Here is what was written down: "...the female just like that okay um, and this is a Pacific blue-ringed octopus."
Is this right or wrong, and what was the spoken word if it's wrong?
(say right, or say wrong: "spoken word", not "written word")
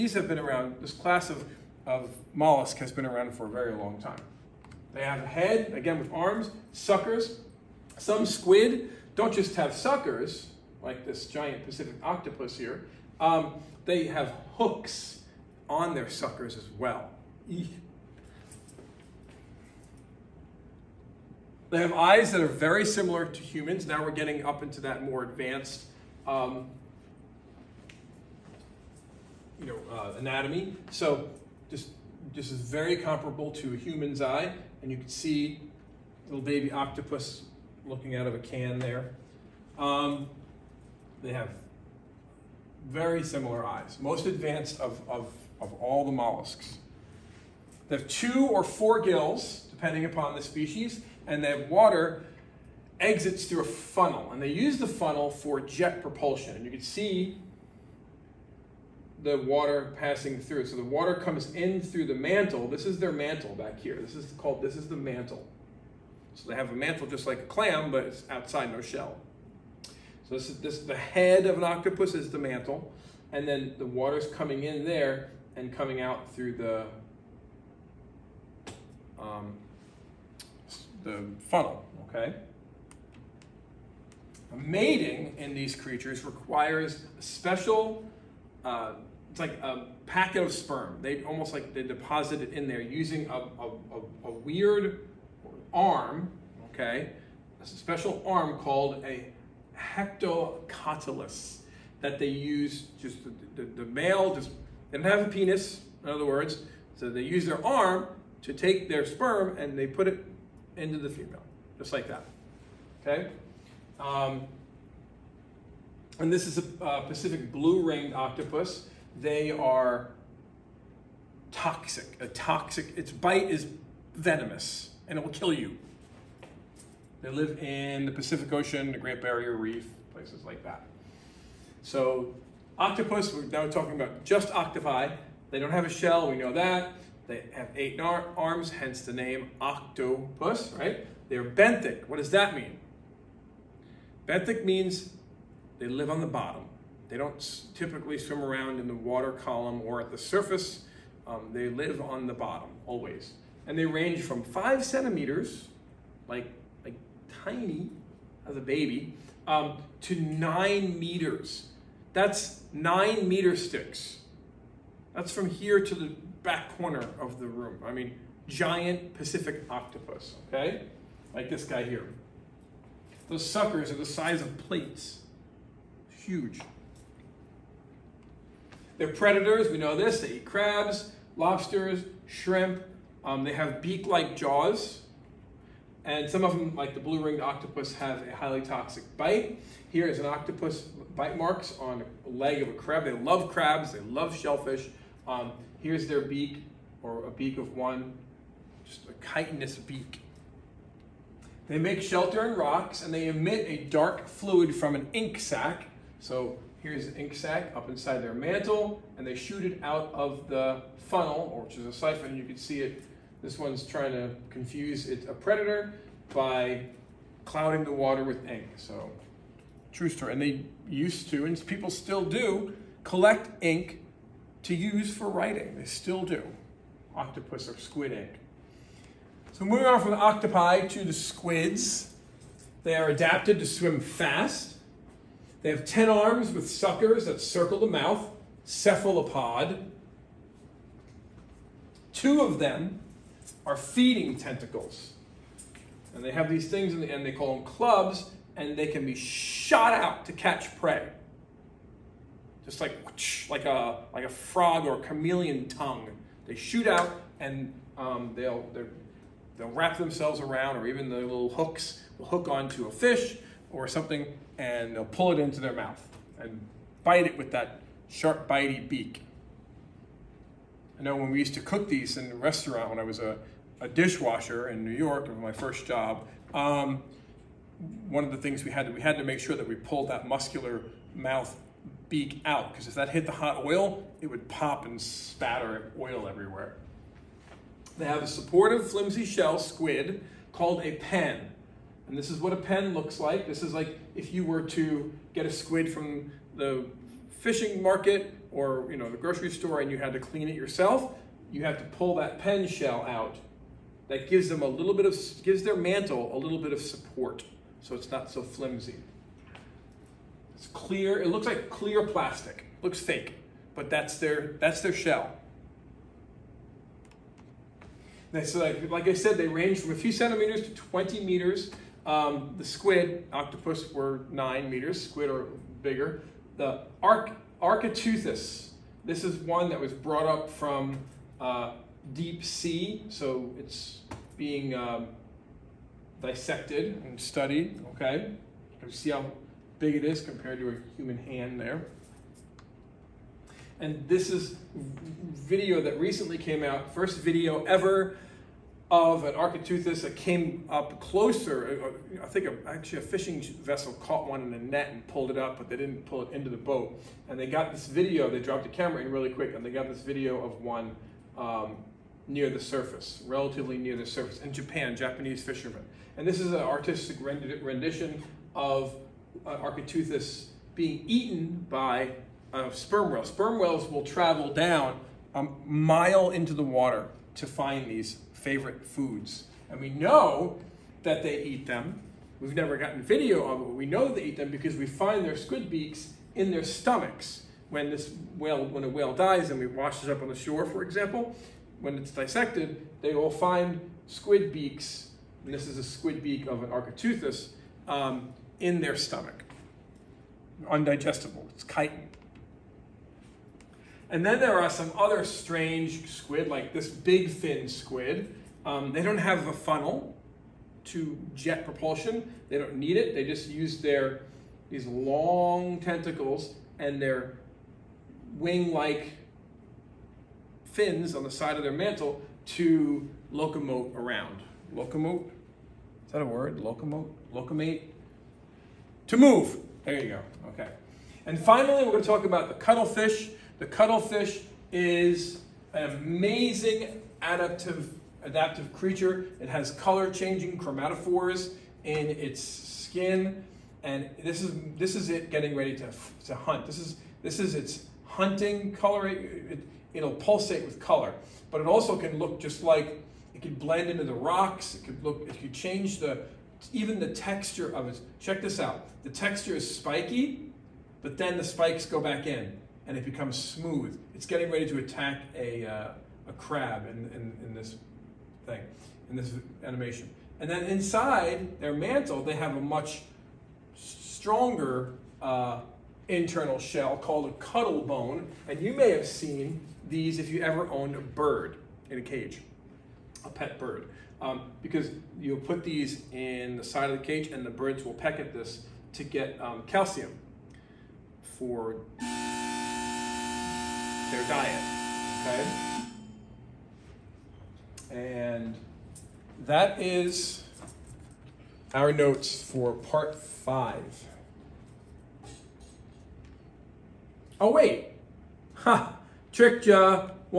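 right.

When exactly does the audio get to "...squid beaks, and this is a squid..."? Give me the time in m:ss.
6:34.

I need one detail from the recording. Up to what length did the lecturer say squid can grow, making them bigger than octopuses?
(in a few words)
20 meters.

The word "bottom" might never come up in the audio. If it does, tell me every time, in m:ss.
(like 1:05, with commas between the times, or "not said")
2:26, 2:32.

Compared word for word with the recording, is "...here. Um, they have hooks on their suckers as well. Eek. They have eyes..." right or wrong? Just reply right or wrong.
right.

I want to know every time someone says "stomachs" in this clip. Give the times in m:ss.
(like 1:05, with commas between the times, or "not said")
6:26, 6:38.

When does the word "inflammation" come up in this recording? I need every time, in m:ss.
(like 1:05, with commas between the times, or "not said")
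not said.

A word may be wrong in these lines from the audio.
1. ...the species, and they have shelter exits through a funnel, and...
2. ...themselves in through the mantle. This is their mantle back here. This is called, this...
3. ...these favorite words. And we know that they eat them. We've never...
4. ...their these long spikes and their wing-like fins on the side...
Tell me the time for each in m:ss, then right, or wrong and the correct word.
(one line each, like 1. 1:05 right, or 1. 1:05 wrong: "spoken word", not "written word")
1. 0:50 wrong: "water", not "shelter"
2. 1:01 wrong: "comes", not "themselves"
3. 6:17 wrong: "foods", not "words"
4. 6:53 wrong: "tentacles", not "spikes".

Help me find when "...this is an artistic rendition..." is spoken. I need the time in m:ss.
6:06.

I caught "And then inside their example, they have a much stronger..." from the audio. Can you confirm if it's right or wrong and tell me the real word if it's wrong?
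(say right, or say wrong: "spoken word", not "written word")
wrong: "mantle", not "example".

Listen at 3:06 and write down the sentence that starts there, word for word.
And some of them, like the blue-ringed octopus, have a highly toxic bite.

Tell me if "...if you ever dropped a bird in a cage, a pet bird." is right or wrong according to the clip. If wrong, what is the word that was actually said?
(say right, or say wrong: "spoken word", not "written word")
wrong: "owned", not "dropped".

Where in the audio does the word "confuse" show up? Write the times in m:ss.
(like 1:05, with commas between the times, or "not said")
3:34.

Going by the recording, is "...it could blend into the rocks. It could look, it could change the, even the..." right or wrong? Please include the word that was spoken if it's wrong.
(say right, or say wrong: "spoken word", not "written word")
right.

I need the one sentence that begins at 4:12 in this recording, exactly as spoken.
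Just like, like, a, like a frog or a chameleon tongue.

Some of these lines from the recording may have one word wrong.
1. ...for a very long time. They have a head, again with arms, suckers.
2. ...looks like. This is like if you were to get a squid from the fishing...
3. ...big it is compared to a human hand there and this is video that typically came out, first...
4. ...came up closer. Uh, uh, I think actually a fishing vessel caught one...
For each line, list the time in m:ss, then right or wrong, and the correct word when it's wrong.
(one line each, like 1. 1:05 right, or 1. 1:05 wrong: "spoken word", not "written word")
1. 0:03 right
2. 4:52 right
3. 5:39 wrong: "recently", not "typically"
4. 5:50 right.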